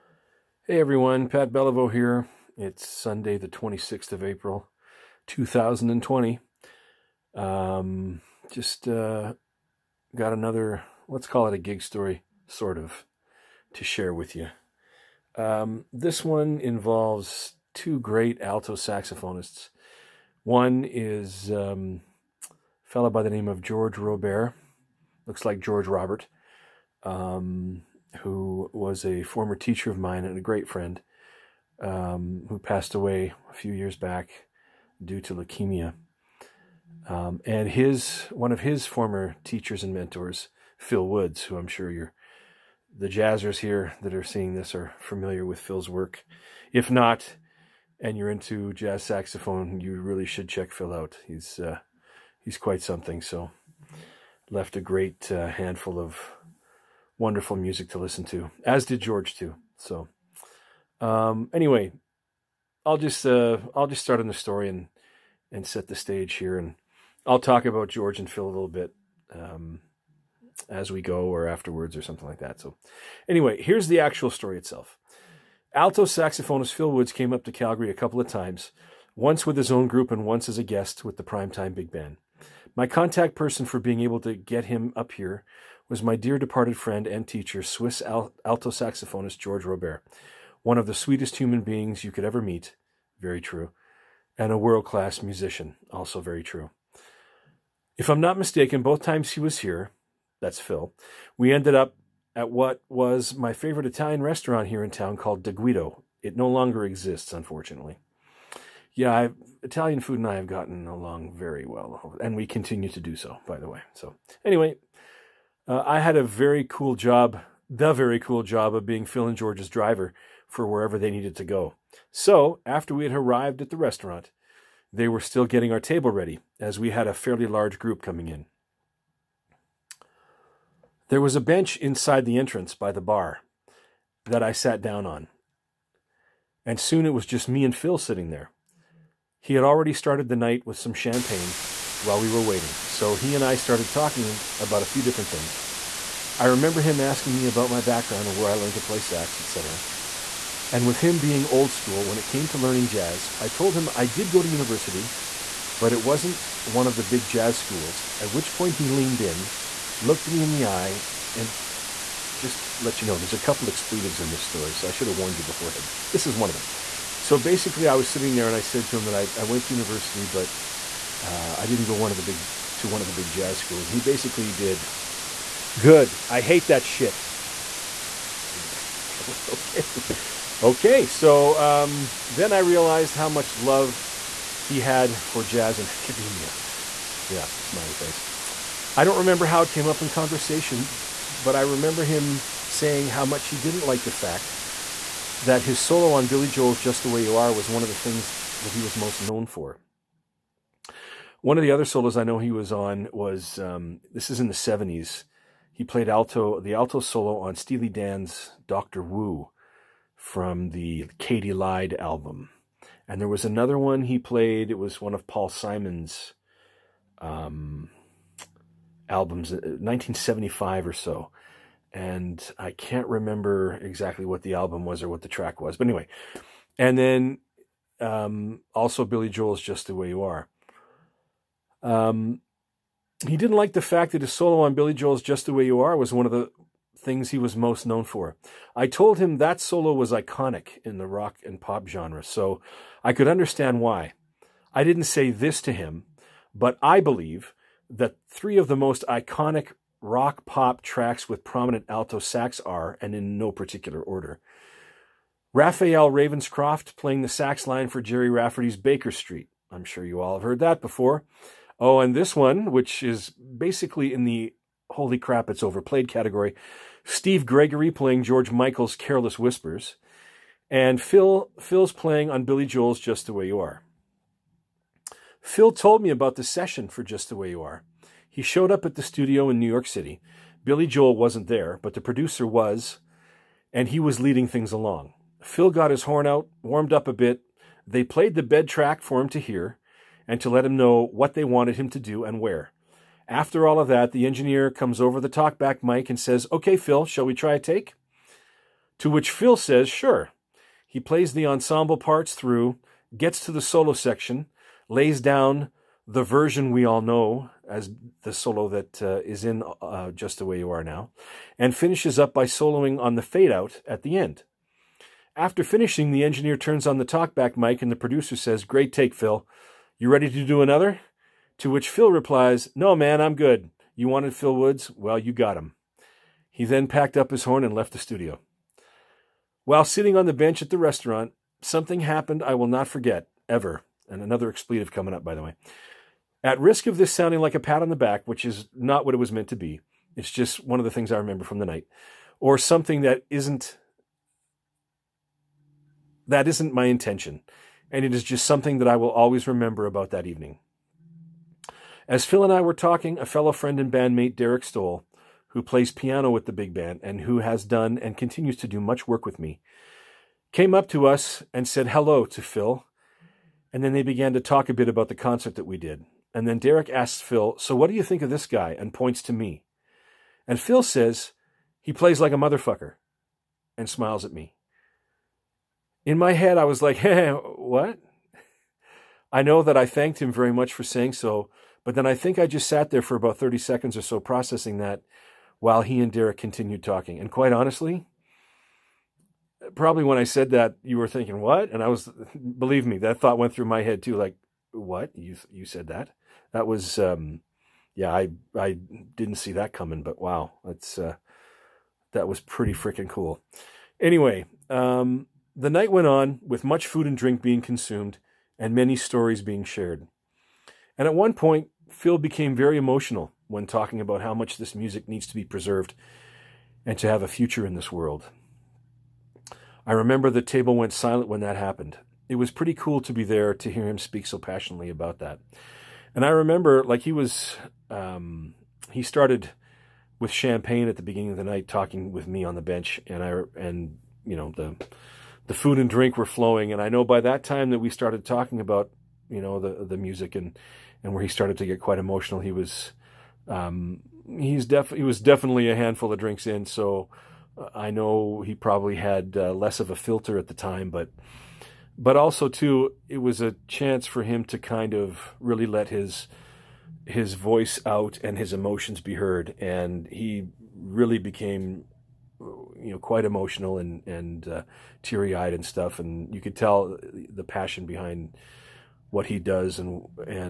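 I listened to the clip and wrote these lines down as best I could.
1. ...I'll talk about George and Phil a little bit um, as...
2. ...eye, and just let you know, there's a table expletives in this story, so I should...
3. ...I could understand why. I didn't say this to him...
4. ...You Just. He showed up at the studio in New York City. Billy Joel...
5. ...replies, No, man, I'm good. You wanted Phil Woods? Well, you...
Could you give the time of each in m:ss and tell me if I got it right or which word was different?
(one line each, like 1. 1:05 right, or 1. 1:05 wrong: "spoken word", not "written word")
1. 1:07 right
2. 2:40 wrong: "couple", not "table"
3. 4:03 right
4. 4:37 wrong: "Are", not "Just"
5. 5:22 right.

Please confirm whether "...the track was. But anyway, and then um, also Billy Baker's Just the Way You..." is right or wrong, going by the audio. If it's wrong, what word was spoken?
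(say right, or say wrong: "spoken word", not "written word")
wrong: "Joel", not "Baker".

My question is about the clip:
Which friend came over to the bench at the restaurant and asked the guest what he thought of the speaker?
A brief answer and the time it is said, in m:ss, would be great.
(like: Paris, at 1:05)
Derek Stoll, at 5:54.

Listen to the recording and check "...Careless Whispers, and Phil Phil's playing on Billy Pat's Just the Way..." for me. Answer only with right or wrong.
wrong.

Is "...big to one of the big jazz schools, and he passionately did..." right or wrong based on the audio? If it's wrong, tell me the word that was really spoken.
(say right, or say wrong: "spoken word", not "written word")
wrong: "basically", not "passionately".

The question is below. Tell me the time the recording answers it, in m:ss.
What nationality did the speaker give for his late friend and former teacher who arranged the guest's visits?
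1:27.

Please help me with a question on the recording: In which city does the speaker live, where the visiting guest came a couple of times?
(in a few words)
Calgary.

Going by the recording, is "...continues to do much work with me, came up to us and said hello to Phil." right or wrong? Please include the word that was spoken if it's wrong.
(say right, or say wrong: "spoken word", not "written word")
right.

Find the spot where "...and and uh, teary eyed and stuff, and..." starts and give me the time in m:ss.
7:43.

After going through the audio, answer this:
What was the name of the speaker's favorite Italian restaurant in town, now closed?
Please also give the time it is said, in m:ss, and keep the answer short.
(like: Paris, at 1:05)
De Guido, at 1:45.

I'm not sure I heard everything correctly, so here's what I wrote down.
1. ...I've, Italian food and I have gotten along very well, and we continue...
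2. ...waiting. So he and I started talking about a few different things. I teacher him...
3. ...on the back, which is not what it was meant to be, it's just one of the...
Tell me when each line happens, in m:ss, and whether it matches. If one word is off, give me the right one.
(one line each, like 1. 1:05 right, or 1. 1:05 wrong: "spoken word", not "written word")
1. 1:49 right
2. 2:22 wrong: "remember", not "teacher"
3. 5:37 right.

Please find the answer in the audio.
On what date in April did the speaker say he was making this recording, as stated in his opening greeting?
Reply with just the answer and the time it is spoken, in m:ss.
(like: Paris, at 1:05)
26th of April, at 0:03.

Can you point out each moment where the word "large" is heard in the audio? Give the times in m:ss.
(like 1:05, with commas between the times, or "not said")
2:07.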